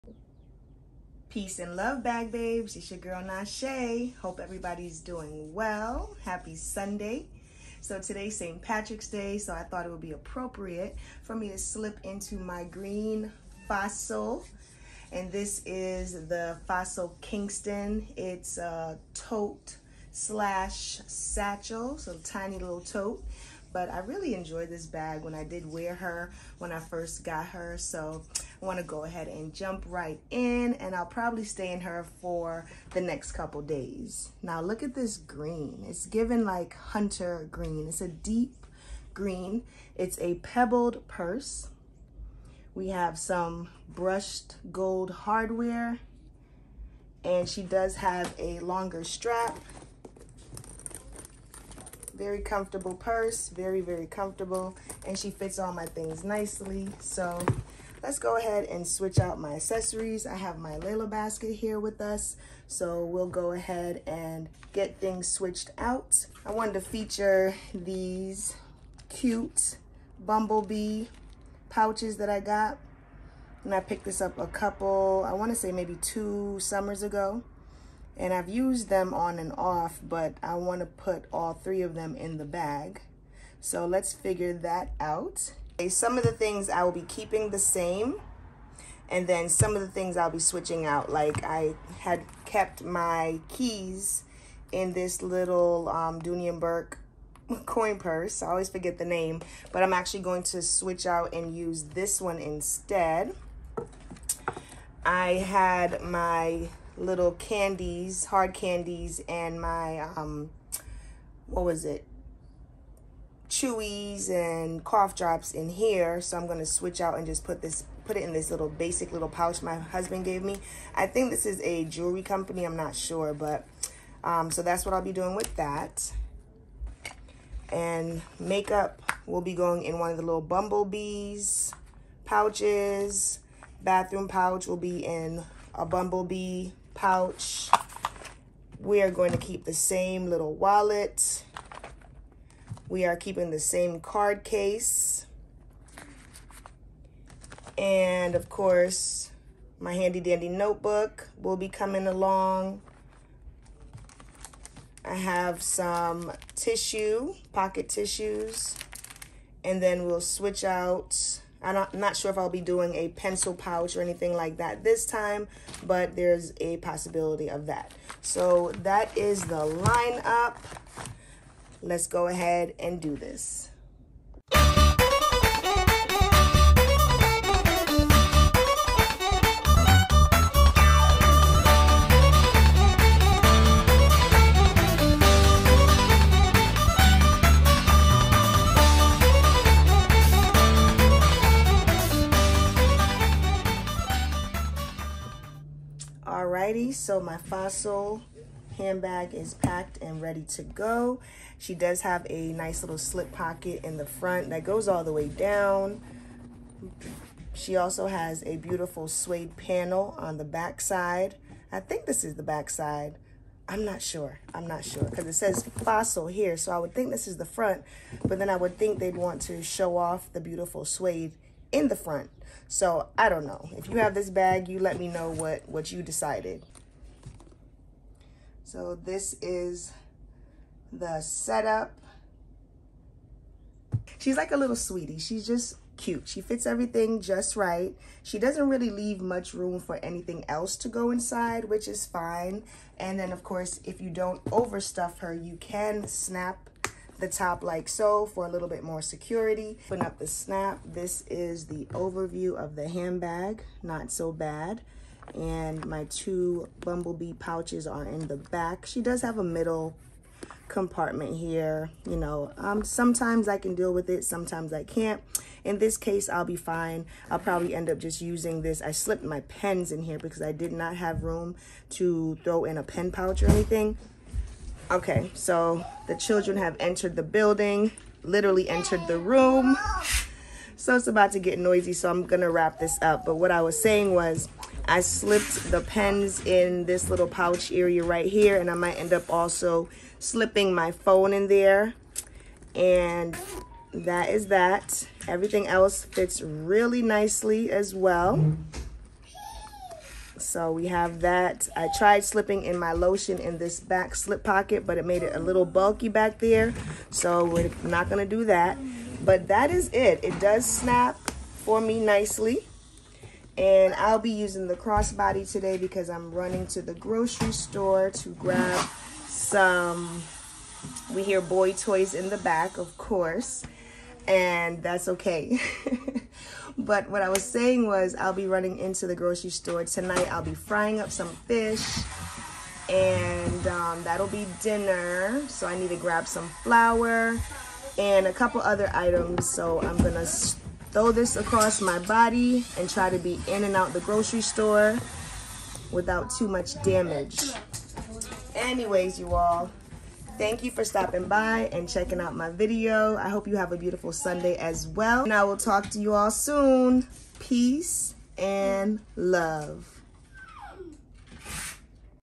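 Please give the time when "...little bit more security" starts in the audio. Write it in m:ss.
4:08.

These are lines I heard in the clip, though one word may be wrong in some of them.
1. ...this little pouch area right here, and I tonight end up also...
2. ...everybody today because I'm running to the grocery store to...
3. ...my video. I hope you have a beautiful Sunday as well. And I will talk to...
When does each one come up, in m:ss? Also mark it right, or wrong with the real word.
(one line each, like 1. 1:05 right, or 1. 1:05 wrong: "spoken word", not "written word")
1. 4:46 wrong: "might", not "tonight"
2. 5:14 wrong: "crossbody", not "everybody"
3. 5:52 right.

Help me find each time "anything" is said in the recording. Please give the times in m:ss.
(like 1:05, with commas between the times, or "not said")
2:44, 3:59, 4:33.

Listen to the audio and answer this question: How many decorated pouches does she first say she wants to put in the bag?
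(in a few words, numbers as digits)
3.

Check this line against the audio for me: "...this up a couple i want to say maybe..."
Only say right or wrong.
right.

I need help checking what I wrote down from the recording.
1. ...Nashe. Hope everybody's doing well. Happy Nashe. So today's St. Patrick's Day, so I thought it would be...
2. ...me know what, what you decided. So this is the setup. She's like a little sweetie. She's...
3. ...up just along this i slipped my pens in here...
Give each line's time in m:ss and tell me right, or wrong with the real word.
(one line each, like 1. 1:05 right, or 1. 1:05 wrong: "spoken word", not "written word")
1. 0:03 wrong: "Sunday", not "Nashe"
2. 3:44 right
3. 4:27 wrong: "using", not "along".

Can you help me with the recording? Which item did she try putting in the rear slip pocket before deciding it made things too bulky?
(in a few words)
Lotion.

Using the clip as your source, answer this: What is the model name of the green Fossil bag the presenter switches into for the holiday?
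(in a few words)
Kingston.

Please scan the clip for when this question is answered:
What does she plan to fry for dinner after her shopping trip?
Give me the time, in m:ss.
5:31.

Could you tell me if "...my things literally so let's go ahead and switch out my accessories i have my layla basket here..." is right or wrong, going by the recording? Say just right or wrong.
wrong.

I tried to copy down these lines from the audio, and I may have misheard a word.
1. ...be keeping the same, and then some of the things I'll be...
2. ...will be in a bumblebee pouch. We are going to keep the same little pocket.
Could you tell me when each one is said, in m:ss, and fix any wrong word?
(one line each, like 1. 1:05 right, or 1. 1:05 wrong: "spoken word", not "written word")
1. 1:26 right
2. 2:14 wrong: "wallet", not "pocket".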